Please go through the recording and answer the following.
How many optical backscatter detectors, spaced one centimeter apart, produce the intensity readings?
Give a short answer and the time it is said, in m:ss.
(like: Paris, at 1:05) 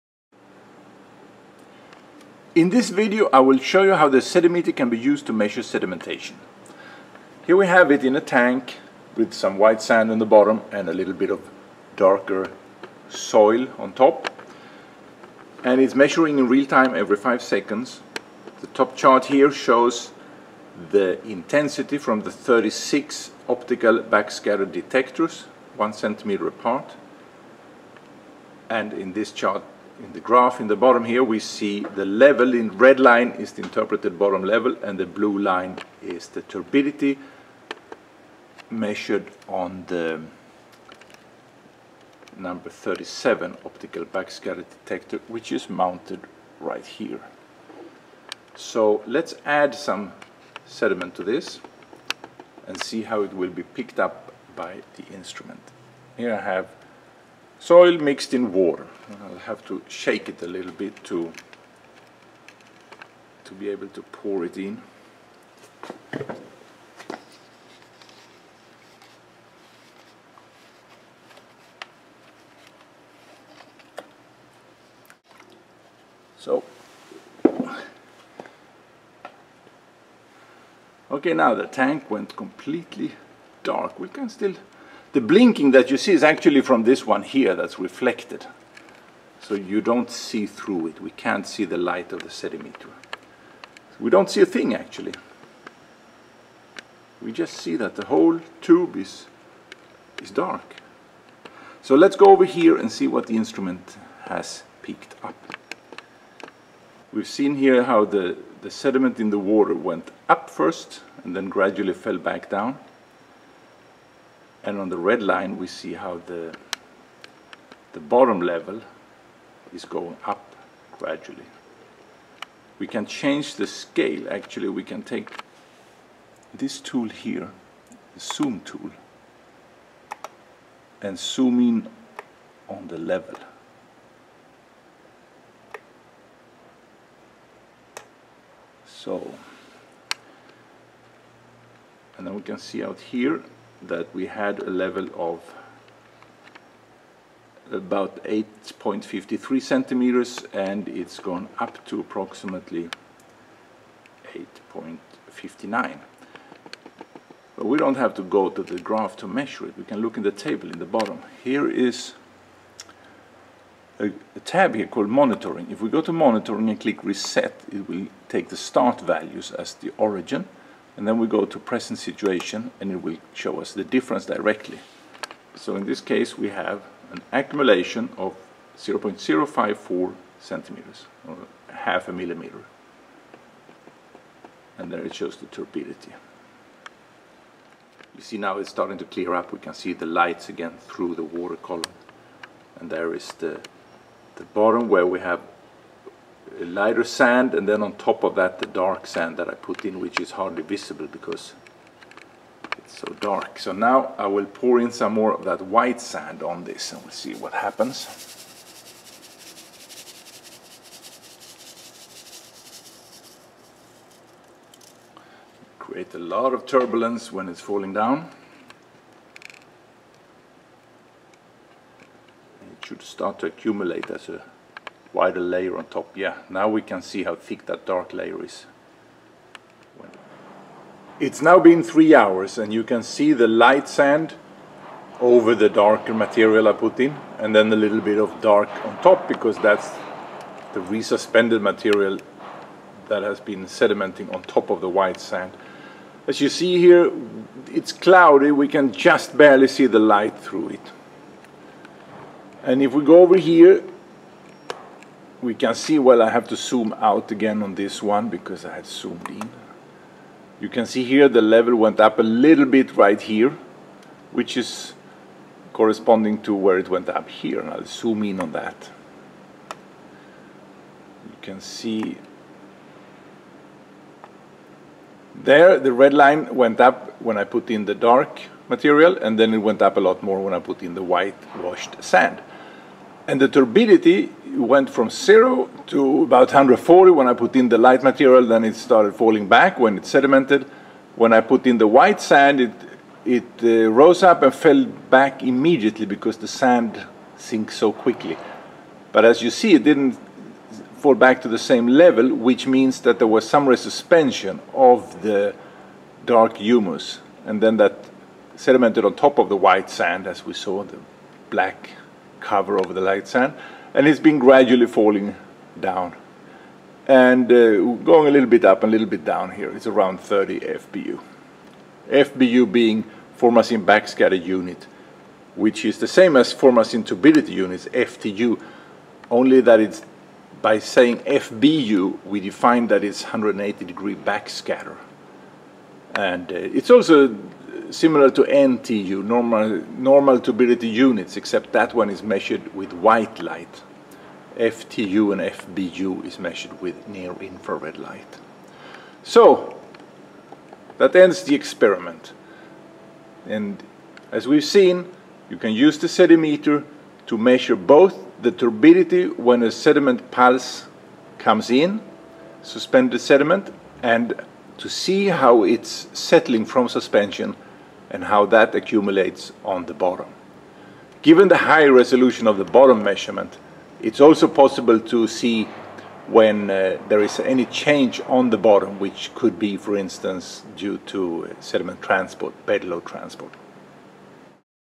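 36, at 0:22.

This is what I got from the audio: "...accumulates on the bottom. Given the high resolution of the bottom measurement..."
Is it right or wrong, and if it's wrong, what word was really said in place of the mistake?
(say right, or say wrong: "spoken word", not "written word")
right.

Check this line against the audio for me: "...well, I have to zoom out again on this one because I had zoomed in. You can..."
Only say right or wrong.
right.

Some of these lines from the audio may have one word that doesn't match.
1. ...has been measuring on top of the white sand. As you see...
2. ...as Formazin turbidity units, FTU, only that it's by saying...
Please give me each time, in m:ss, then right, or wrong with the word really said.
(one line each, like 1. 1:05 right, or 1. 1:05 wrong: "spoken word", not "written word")
1. 4:03 wrong: "sedimenting", not "measuring"
2. 5:26 right.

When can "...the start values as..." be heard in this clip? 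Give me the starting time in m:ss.
2:48.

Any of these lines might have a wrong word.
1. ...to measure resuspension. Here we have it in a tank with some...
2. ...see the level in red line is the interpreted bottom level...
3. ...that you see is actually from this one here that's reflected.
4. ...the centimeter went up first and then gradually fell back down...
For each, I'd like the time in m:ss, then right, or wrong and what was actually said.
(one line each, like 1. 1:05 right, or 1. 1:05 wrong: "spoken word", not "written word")
1. 0:05 wrong: "sedimentation", not "resuspension"
2. 0:31 right
3. 1:25 right
4. 1:49 wrong: "water", not "centimeter".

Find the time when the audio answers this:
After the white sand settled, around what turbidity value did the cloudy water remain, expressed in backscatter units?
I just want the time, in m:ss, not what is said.
5:20.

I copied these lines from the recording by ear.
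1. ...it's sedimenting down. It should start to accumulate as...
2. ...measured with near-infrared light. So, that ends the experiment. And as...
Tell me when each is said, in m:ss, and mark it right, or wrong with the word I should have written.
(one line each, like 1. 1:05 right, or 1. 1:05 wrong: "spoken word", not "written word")
1. 3:37 wrong: "falling", not "sedimenting"
2. 5:46 right.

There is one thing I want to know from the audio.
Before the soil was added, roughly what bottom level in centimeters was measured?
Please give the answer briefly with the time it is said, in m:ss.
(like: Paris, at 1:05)
8.53 centimeters, at 2:28.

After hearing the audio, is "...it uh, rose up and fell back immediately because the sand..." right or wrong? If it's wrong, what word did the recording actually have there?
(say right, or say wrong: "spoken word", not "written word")
right.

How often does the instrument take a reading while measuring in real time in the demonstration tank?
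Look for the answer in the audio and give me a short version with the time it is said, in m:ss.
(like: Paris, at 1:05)
every 5 seconds, at 0:16.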